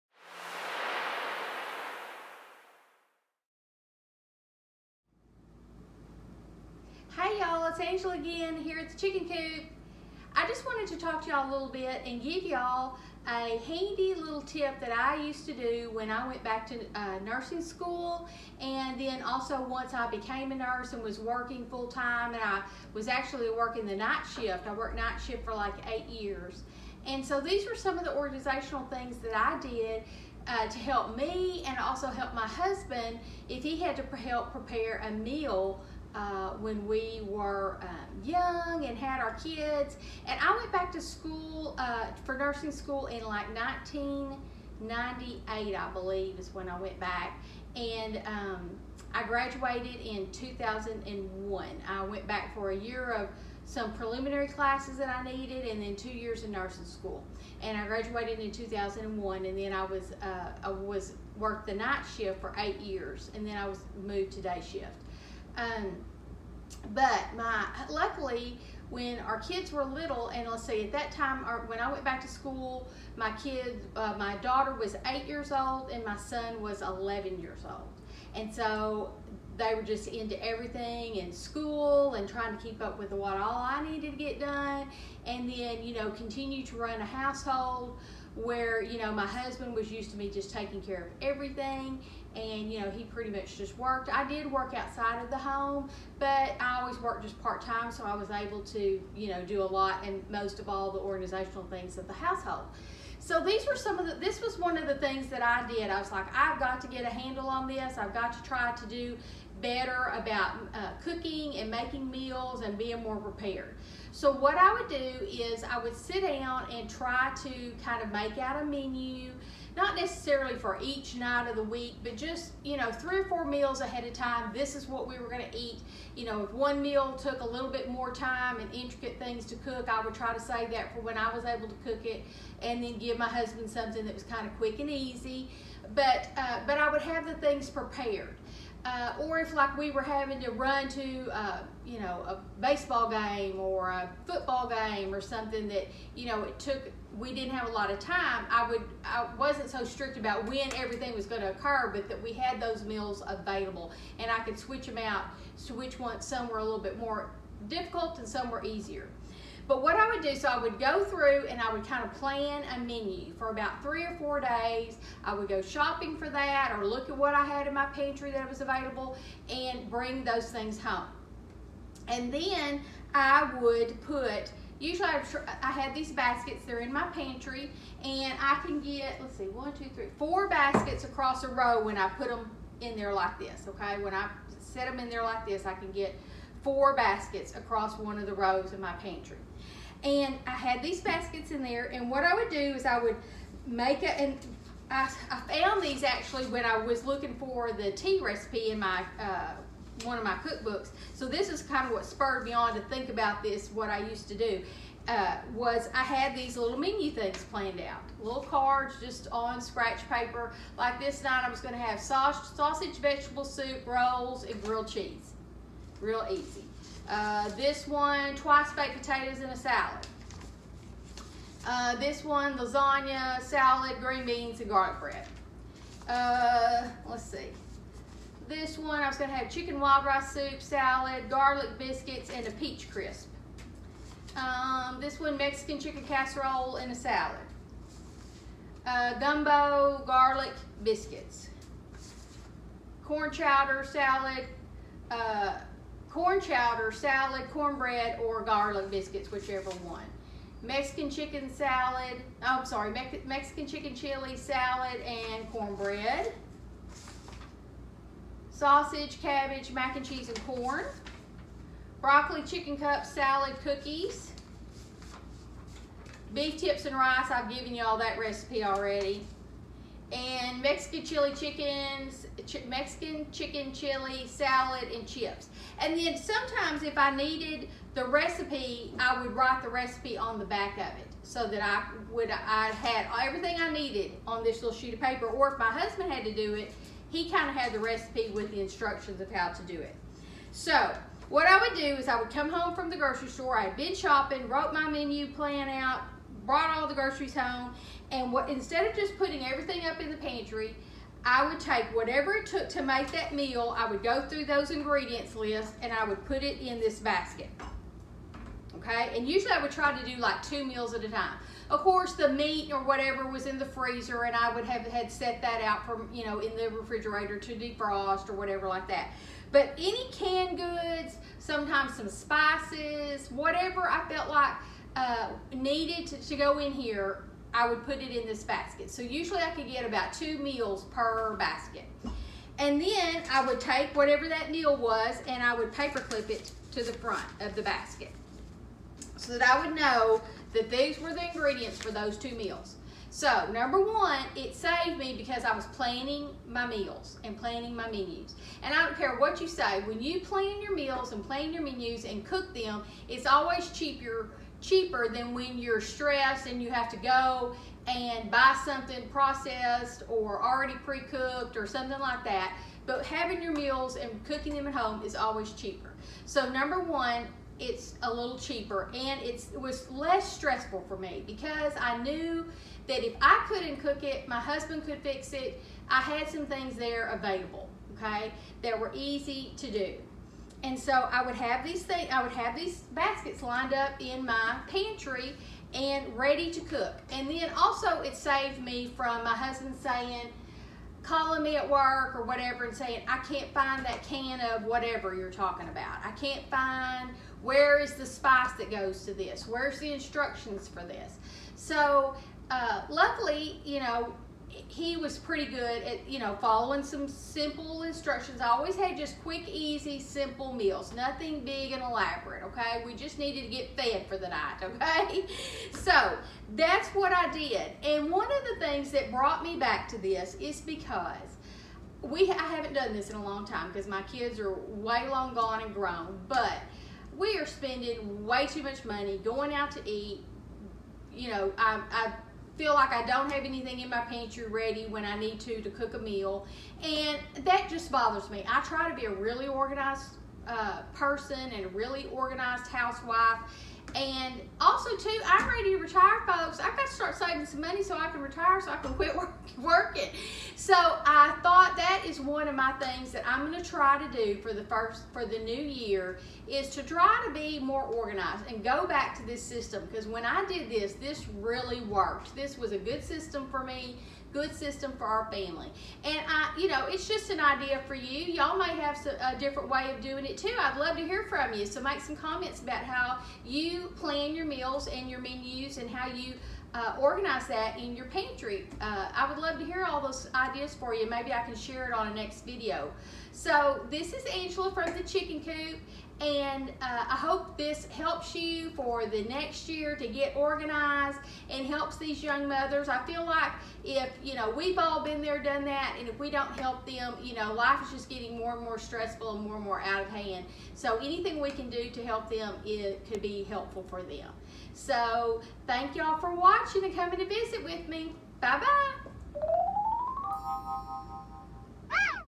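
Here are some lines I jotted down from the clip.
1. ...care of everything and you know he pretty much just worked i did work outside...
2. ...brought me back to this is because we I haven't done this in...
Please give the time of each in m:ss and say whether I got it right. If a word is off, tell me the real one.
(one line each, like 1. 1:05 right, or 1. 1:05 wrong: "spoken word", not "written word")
1. 1:30 right
2. 6:59 right.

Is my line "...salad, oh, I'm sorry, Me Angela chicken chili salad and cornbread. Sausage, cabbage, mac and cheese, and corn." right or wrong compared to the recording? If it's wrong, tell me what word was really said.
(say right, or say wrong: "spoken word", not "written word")
wrong: "Mexican", not "Angela".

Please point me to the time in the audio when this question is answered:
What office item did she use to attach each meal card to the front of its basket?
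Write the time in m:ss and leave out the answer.
5:35.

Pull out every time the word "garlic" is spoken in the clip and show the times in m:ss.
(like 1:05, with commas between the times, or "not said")
3:44, 3:51, 4:00, 4:08.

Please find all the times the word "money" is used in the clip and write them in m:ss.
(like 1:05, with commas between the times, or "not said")
7:08, 7:27.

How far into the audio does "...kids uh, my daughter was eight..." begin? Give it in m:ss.
1:13.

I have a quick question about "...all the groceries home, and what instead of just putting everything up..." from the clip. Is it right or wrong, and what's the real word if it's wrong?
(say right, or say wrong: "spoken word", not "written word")
right.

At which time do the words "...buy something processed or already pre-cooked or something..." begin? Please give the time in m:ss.
5:58.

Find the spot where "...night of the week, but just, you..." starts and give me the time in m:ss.
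2:01.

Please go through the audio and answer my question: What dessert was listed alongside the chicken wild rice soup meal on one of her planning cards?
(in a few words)
peach crisp.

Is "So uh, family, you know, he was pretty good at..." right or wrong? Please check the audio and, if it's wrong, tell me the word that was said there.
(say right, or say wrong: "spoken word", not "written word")
wrong: "luckily", not "family".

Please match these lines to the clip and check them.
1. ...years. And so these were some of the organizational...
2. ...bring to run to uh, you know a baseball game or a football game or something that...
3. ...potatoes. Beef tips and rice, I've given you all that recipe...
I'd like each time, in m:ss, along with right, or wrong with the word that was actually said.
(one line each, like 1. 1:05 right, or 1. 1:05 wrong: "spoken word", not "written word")
1. 0:26 right
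2. 2:20 wrong: "having", not "bring"
3. 4:23 wrong: "cookies", not "potatoes".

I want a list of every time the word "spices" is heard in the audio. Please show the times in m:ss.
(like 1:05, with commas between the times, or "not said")
5:22, 6:38.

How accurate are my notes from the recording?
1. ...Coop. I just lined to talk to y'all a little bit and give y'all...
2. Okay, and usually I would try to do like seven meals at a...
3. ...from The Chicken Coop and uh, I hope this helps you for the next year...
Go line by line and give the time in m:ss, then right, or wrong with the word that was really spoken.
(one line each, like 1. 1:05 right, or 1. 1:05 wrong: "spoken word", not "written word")
1. 0:09 wrong: "wanted", not "lined"
2. 5:08 wrong: "two", not "seven"
3. 8:04 right.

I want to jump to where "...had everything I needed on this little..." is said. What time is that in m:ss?
4:42.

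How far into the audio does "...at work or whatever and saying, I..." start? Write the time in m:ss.
6:31.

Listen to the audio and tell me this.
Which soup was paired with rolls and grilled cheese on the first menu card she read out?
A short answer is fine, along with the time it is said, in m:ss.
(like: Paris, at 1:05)
sausage vegetable soup, at 3:32.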